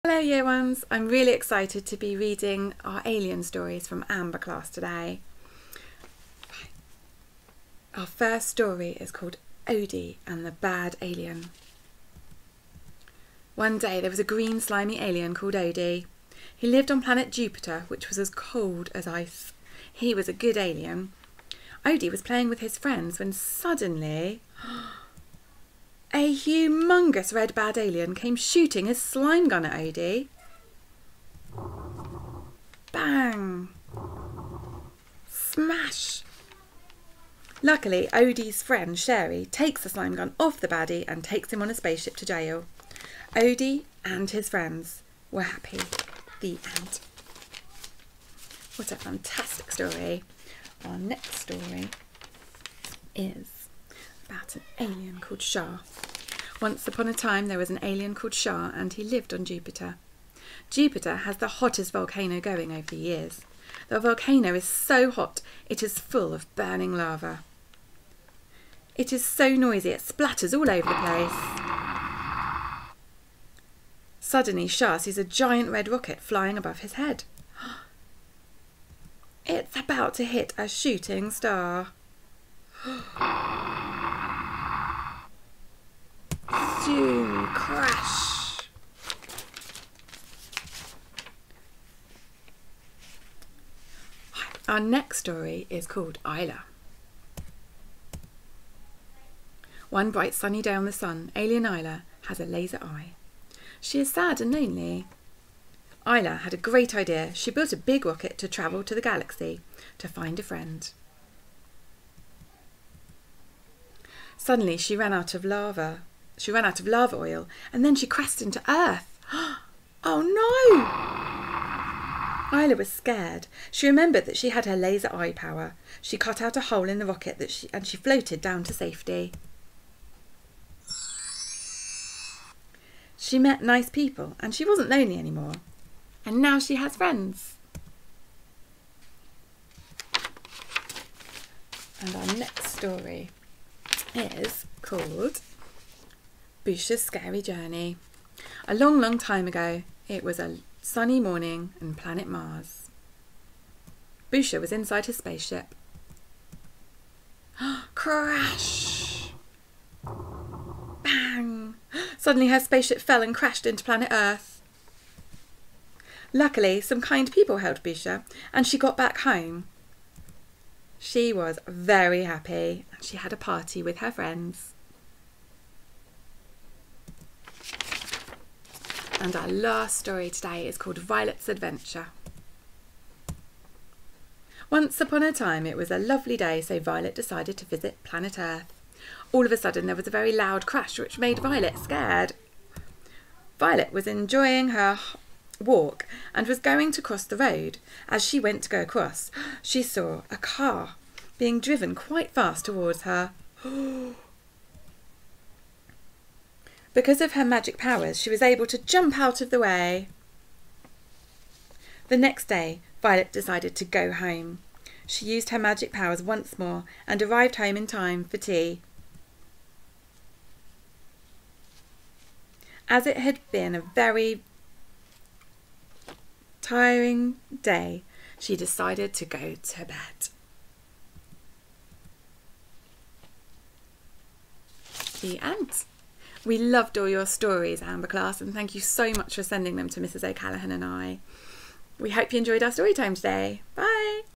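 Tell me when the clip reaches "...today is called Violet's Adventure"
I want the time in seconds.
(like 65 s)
180 s.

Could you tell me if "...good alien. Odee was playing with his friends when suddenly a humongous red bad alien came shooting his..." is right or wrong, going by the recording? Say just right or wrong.
right.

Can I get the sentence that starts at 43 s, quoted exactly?
Odee and his friends were happy.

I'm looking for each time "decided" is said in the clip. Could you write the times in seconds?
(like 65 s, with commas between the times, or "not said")
187 s, 213 s, 228 s.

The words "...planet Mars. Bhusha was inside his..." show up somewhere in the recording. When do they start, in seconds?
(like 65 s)
151 s.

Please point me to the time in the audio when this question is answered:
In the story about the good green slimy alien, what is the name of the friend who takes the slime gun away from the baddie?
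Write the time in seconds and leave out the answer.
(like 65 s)
38 s.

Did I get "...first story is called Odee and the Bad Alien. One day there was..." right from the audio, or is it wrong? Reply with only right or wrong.
right.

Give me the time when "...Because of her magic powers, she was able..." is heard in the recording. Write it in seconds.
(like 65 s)
206 s.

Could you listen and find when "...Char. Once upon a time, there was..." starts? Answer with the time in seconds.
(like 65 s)
55 s.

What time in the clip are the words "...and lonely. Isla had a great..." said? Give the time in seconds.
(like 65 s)
104 s.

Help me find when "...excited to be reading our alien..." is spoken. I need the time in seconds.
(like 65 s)
1 s.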